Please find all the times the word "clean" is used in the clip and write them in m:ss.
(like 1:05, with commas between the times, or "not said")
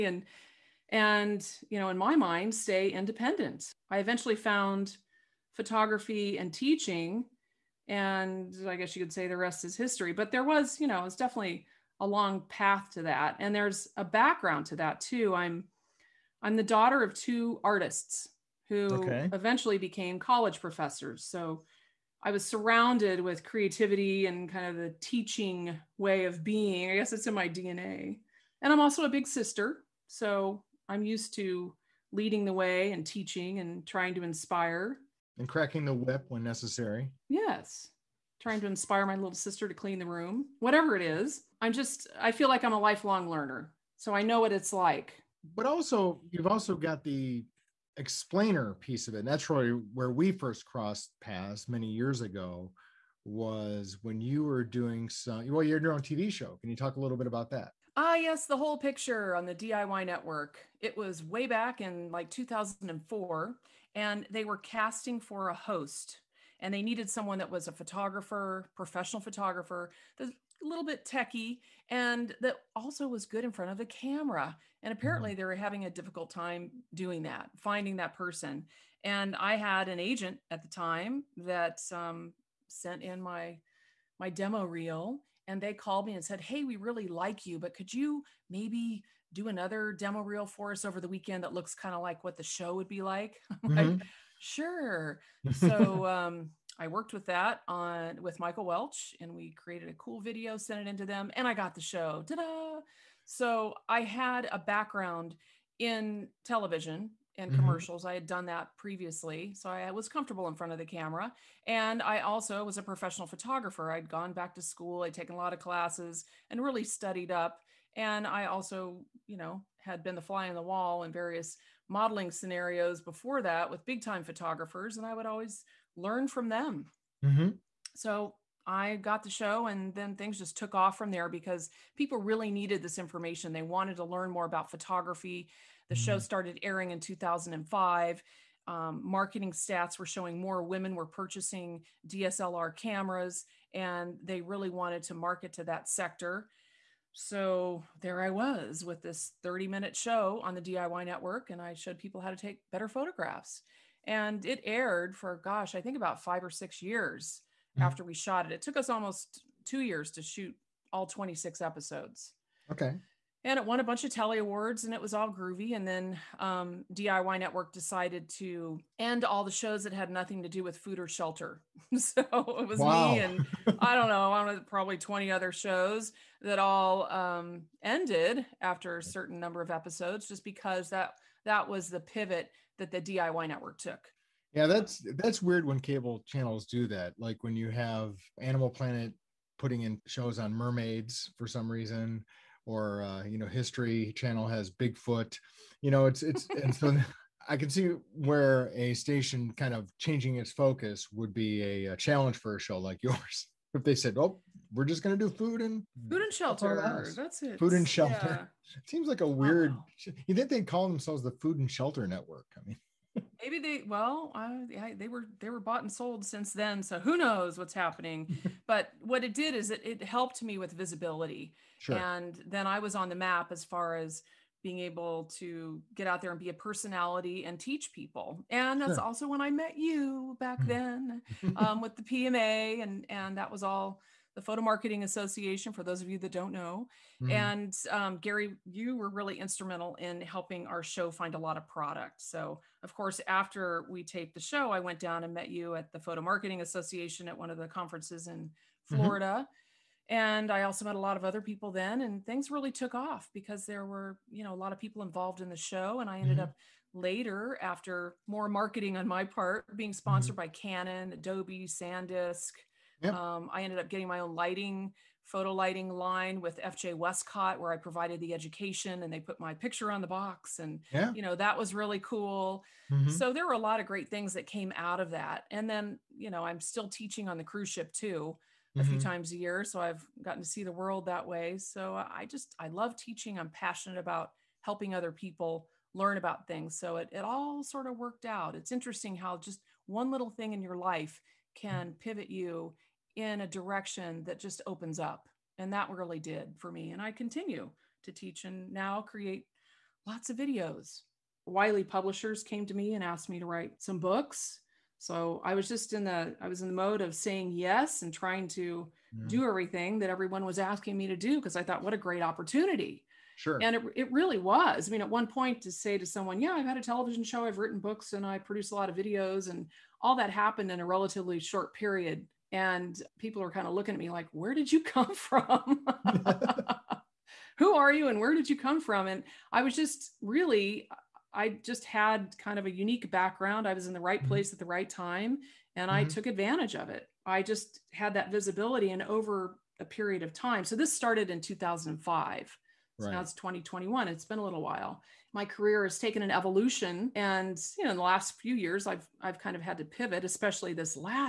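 0:39.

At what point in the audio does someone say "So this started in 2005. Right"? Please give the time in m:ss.
5:40.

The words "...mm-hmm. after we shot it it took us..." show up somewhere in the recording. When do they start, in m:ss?
2:37.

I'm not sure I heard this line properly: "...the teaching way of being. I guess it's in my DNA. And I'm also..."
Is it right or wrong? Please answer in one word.
right.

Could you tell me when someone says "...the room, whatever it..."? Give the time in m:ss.
0:39.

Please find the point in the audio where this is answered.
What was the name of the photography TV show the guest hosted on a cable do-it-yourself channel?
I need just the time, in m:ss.
0:58.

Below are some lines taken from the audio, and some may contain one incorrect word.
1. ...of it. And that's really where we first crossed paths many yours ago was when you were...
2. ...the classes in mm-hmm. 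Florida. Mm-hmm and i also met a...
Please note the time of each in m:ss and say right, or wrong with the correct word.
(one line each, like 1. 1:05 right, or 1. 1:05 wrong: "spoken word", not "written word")
1. 0:49 wrong: "years", not "yours"
2. 4:07 wrong: "conferences", not "classes".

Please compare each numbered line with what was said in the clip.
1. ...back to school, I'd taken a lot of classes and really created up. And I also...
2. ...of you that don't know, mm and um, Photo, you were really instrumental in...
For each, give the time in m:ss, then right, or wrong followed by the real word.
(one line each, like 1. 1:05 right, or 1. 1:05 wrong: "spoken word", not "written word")
1. 1:54 wrong: "studied", not "created"
2. 3:56 wrong: "Gary", not "Photo".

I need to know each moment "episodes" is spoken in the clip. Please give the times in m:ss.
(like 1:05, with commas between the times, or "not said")
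2:41, 2:59.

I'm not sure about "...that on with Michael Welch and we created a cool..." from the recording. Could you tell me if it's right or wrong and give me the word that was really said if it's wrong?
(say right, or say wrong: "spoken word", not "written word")
right.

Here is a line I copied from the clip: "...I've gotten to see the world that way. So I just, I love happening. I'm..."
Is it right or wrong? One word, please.
wrong.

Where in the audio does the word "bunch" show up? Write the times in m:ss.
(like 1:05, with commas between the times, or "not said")
2:43.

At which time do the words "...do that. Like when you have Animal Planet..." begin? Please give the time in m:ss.
3:06.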